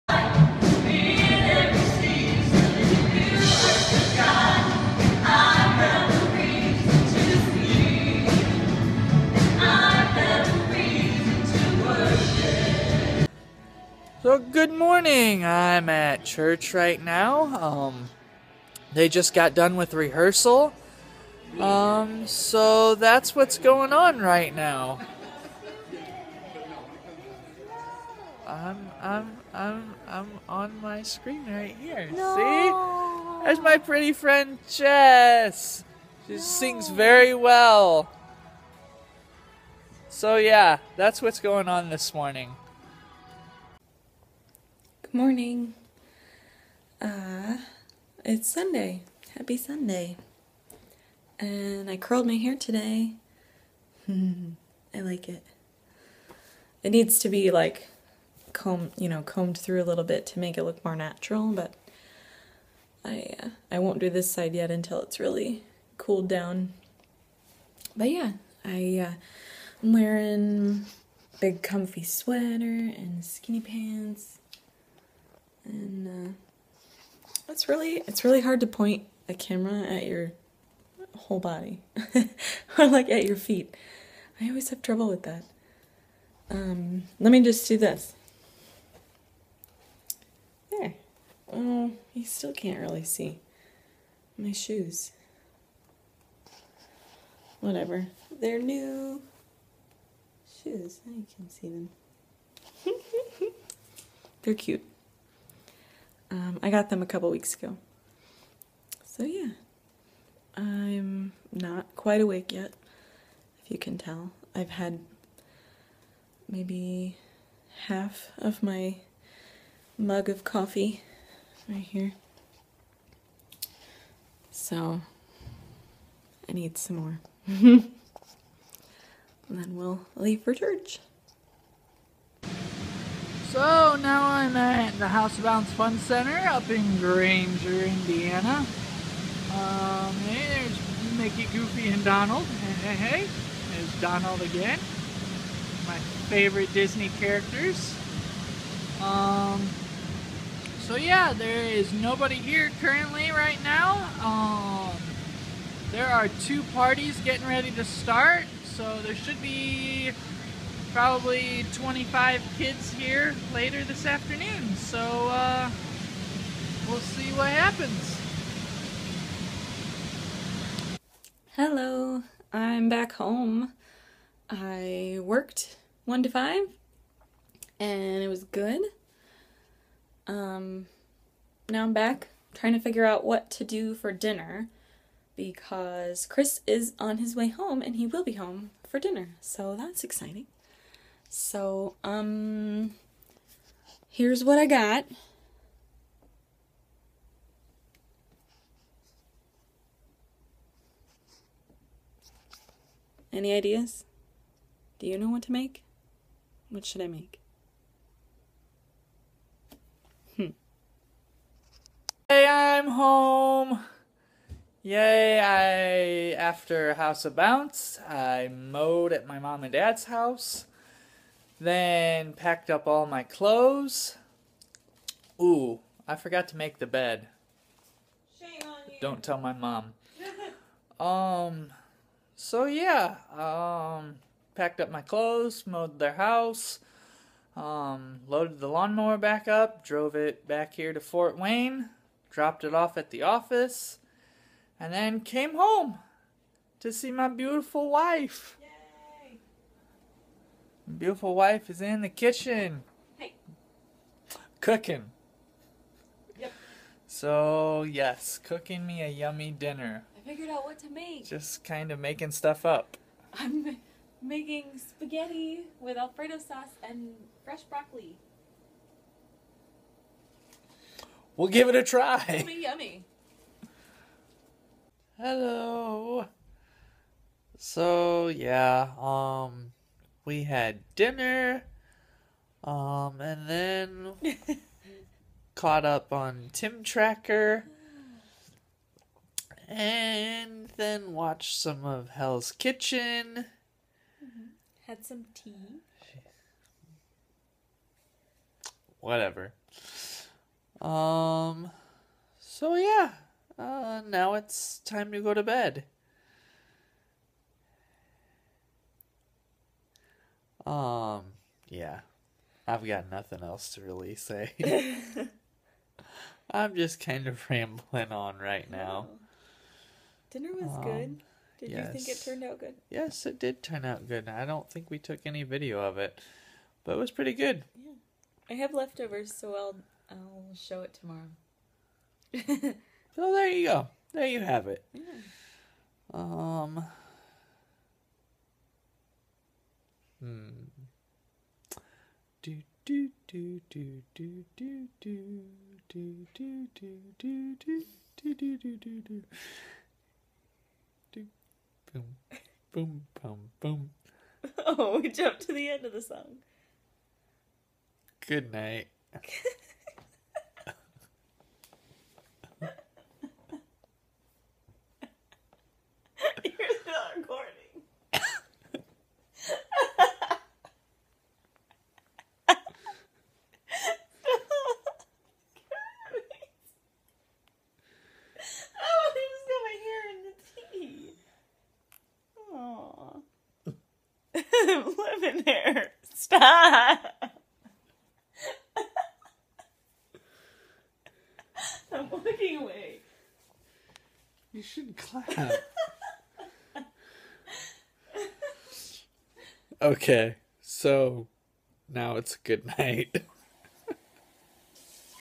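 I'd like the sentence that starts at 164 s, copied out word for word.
So uh, we'll see what happens.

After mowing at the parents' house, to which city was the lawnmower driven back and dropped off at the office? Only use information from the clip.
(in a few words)
Fort Wayne.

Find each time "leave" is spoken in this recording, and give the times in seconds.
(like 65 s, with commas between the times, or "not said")
130 s.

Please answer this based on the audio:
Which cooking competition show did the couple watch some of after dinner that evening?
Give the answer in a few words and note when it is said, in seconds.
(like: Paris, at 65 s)
Hell's Kitchen, at 292 s.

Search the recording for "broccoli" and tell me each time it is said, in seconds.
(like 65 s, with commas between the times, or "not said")
267 s.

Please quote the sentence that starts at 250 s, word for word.
Beautiful wife is in the kitchen.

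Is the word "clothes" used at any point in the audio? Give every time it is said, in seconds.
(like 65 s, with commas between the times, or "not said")
223 s, 235 s.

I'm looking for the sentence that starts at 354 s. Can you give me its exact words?
Oh, we jumped to the end of the song.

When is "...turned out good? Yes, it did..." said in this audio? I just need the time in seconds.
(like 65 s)
322 s.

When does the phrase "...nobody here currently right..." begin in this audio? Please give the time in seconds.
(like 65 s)
151 s.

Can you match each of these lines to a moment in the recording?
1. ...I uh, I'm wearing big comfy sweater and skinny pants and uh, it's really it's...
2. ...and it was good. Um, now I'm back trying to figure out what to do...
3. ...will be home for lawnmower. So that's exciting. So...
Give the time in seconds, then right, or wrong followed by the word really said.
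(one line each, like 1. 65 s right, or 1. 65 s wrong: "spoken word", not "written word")
1. 68 s right
2. 177 s right
3. 188 s wrong: "dinner", not "lawnmower".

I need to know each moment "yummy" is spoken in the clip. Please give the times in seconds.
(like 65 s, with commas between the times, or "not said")
259 s, 272 s.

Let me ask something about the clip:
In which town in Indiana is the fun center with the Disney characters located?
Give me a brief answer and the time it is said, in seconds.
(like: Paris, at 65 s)
Granger, at 136 s.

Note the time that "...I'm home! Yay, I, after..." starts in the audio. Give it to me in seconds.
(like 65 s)
212 s.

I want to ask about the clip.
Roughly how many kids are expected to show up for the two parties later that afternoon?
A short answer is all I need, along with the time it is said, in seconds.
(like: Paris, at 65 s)
25, at 161 s.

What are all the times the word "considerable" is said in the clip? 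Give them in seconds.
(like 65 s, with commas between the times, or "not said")
not said.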